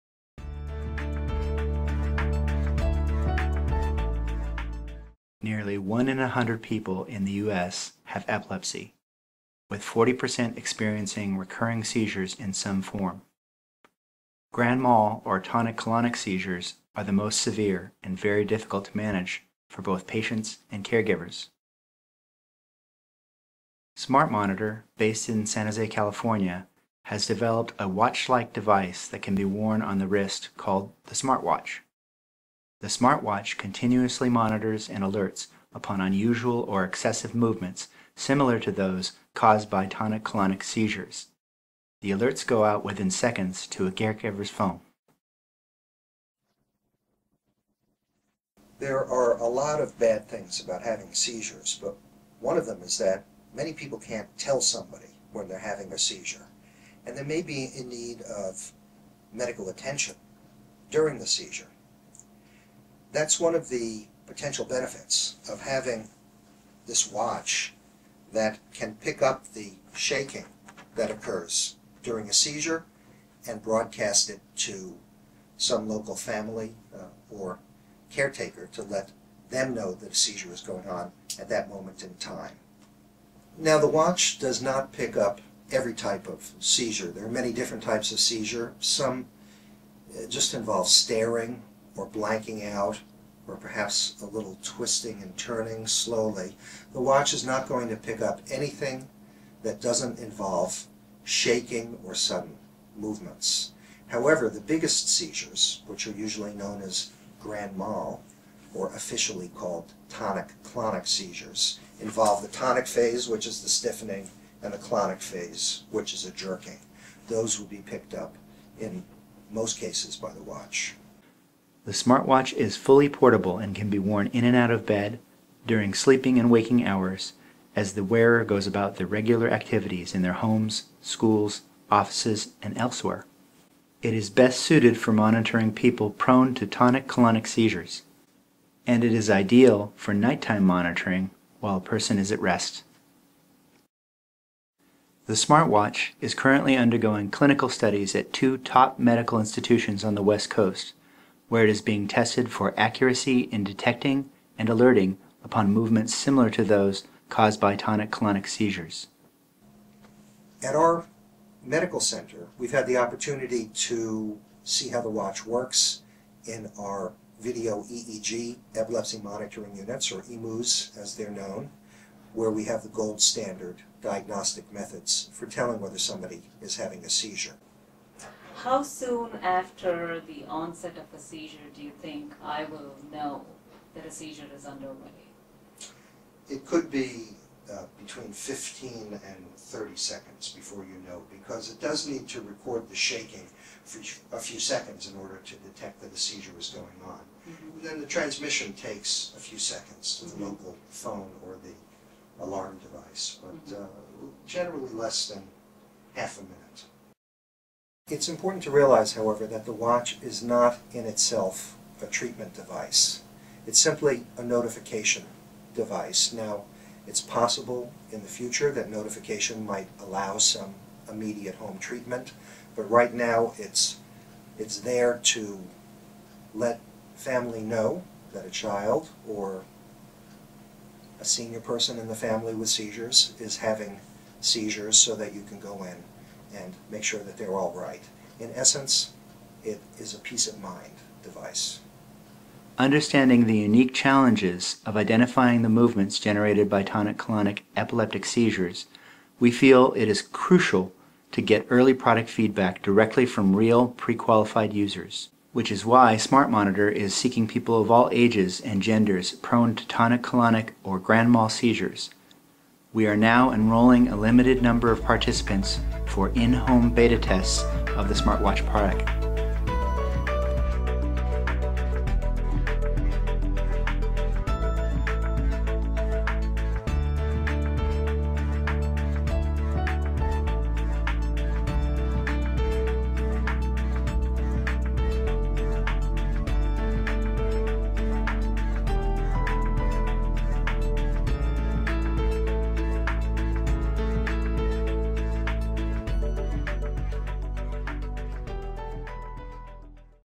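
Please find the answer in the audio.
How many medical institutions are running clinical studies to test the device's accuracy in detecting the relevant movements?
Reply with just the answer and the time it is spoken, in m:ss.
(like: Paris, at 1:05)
2, at 2:28.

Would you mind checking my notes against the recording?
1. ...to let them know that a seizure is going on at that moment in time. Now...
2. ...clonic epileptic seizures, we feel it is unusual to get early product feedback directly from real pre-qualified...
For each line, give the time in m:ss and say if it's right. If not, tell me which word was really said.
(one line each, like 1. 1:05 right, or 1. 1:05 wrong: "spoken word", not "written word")
1. 1:18 right
2. 4:07 wrong: "crucial", not "unusual".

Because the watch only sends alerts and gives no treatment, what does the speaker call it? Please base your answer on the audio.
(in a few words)
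Peace of mind device.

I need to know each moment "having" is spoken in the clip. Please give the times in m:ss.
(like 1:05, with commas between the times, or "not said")
0:50, 0:55, 1:05, 2:56, 3:53.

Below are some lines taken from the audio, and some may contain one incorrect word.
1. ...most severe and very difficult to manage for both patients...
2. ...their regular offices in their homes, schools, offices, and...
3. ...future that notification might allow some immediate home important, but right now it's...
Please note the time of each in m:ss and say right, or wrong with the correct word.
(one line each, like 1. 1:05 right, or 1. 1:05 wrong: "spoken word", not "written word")
1. 0:17 right
2. 2:08 wrong: "activities", not "offices"
3. 3:38 wrong: "treatment", not "important".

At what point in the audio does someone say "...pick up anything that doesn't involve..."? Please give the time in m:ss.
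1:37.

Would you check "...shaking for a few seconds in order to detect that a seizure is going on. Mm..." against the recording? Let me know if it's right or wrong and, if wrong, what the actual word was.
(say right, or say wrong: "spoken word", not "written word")
right.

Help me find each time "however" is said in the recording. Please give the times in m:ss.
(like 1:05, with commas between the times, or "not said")
1:44, 3:29.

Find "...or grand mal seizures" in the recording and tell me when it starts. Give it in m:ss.
4:20.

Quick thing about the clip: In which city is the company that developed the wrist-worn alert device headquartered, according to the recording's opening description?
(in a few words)
San Jose.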